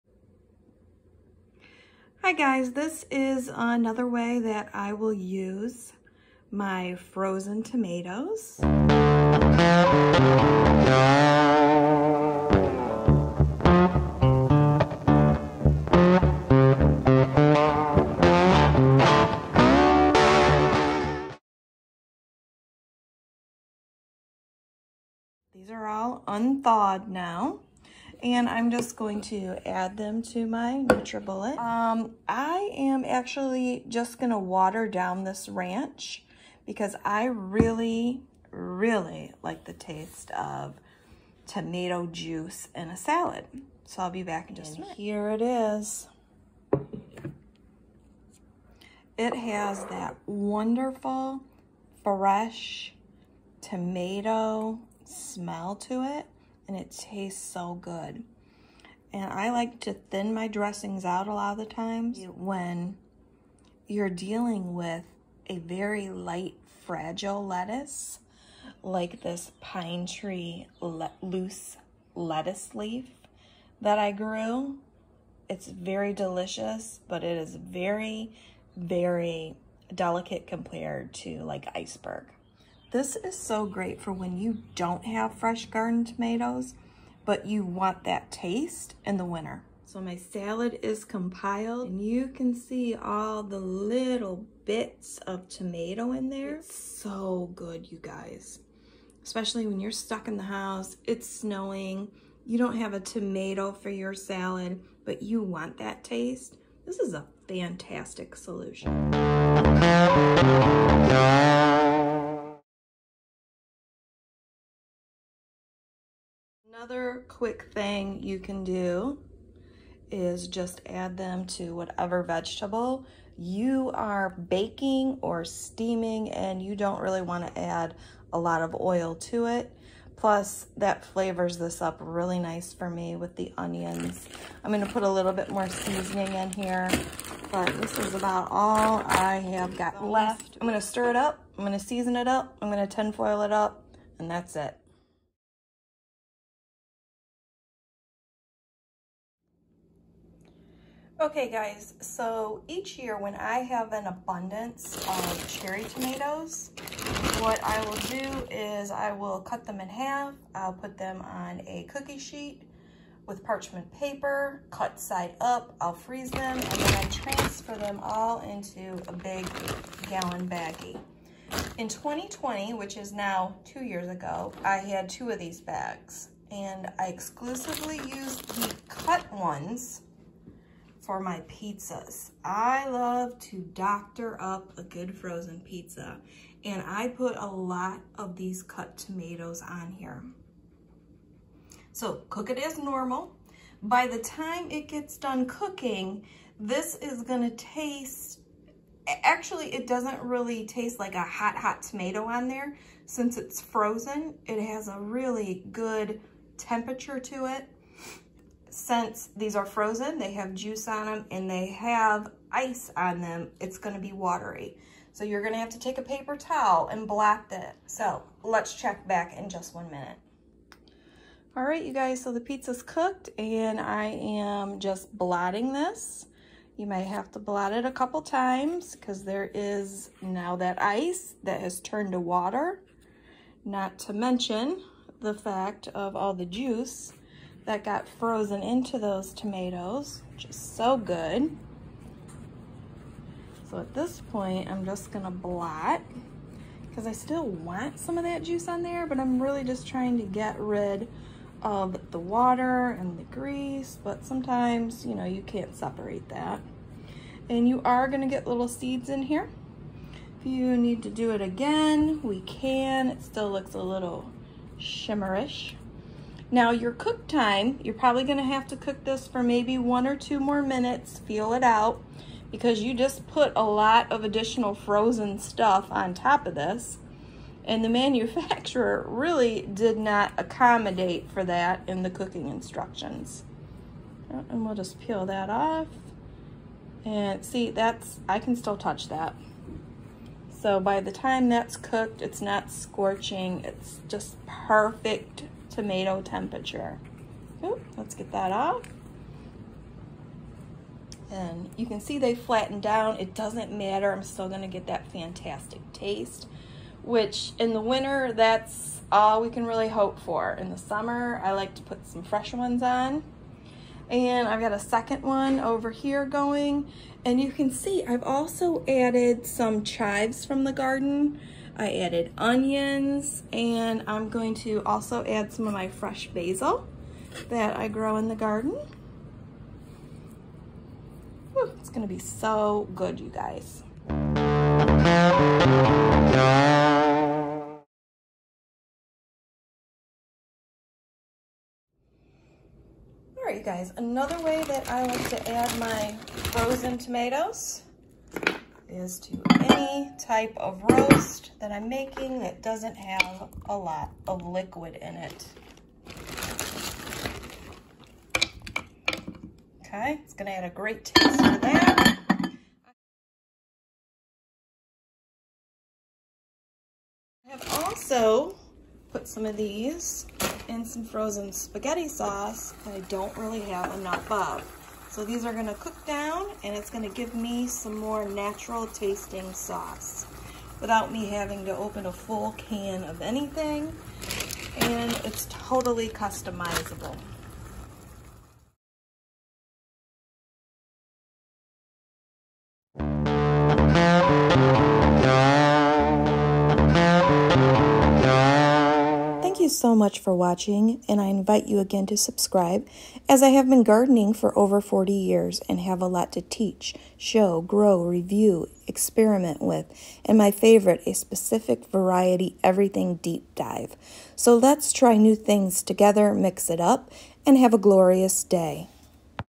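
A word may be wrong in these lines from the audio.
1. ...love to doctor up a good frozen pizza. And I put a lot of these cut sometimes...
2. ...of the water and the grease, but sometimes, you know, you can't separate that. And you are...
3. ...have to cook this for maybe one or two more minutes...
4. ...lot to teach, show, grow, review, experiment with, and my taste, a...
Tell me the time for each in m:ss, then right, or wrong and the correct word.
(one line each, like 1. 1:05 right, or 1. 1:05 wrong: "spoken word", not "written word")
1. 3:02 wrong: "tomatoes", not "sometimes"
2. 4:11 right
3. 4:28 right
4. 6:46 wrong: "favorite", not "taste".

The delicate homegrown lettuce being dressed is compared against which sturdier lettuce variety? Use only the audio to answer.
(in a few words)
Iceberg.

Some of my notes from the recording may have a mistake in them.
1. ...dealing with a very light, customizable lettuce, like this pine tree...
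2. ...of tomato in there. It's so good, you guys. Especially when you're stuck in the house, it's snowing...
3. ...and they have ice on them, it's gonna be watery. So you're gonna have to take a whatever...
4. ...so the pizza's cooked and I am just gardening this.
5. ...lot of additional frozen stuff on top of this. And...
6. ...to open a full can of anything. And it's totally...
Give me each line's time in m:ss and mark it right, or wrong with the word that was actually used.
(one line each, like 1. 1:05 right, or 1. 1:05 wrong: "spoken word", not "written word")
1. 1:04 wrong: "fragile", not "customizable"
2. 1:35 right
3. 3:31 wrong: "paper", not "whatever"
4. 3:42 wrong: "blotting", not "gardening"
5. 4:33 right
6. 6:21 right.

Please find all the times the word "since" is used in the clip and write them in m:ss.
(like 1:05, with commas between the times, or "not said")
3:23, 3:28.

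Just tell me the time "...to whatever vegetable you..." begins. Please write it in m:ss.
2:01.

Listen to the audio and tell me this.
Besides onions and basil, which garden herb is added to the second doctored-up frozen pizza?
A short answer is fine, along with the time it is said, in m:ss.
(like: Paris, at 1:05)
Chives, at 5:19.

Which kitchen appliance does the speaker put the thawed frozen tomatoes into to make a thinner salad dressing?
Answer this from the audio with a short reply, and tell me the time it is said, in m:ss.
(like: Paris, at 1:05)
NutriBullet, at 0:30.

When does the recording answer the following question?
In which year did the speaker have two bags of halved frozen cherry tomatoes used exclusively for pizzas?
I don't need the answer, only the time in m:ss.
2:51.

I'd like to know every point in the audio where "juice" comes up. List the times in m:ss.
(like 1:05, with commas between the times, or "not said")
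0:42, 3:30, 3:56, 4:08.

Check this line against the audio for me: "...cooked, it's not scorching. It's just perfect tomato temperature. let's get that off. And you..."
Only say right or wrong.
right.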